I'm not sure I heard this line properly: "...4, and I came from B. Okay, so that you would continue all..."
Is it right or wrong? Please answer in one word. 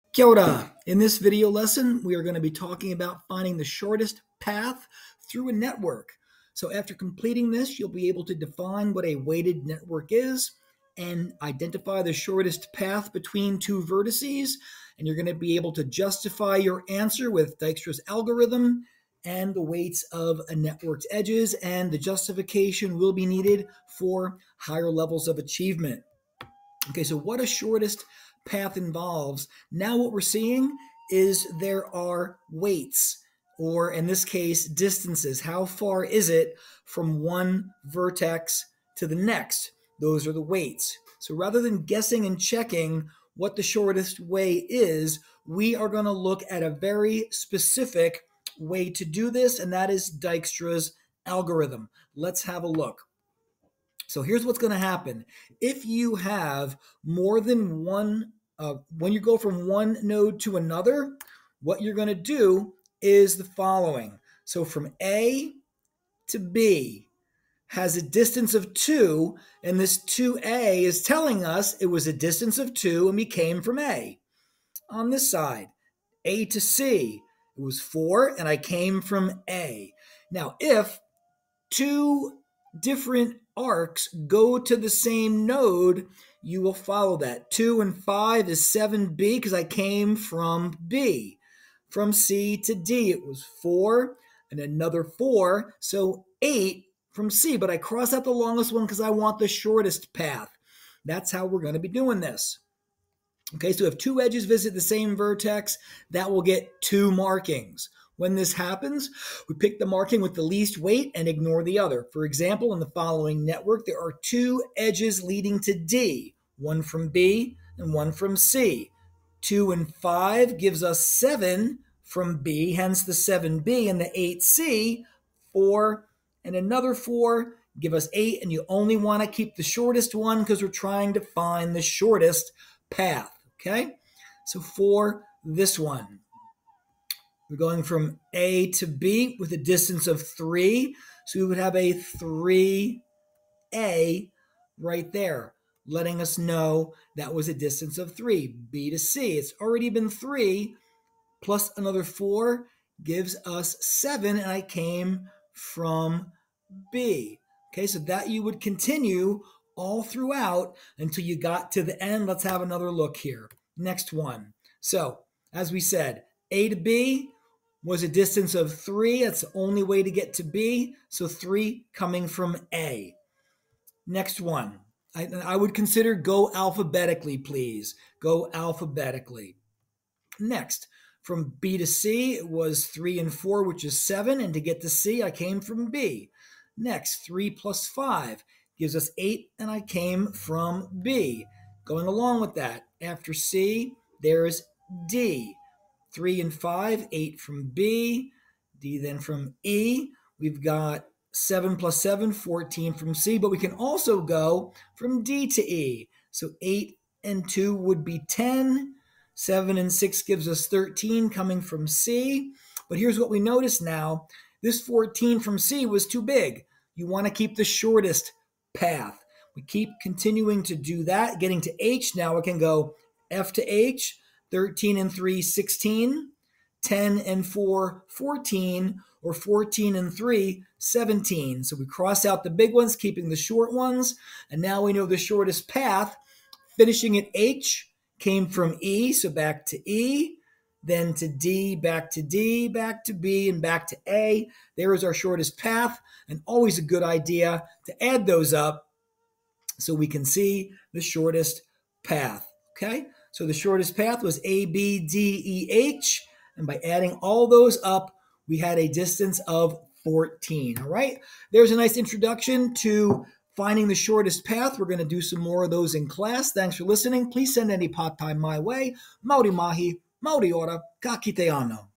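wrong.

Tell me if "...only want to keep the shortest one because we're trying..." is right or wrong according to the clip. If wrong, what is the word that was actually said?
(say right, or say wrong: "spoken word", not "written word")
right.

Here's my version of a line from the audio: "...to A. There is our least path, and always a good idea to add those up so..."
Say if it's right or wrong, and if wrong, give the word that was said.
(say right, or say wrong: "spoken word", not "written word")
wrong: "shortest", not "least".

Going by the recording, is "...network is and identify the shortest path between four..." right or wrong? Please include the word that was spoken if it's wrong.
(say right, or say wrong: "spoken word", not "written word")
wrong: "two", not "four".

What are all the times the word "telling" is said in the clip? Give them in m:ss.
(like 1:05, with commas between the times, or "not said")
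1:11.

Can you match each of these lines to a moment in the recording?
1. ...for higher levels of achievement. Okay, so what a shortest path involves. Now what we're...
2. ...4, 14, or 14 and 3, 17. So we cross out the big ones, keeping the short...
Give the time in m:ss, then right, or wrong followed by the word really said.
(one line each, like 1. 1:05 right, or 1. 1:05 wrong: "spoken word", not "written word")
1. 0:23 right
2. 3:47 right.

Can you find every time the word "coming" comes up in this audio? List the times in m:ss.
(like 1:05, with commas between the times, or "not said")
2:51, 3:31.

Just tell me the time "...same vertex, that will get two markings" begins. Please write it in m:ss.
1:44.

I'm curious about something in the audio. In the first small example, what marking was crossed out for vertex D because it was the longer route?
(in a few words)
8C.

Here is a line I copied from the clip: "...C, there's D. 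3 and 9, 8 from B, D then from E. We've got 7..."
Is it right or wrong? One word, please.
wrong.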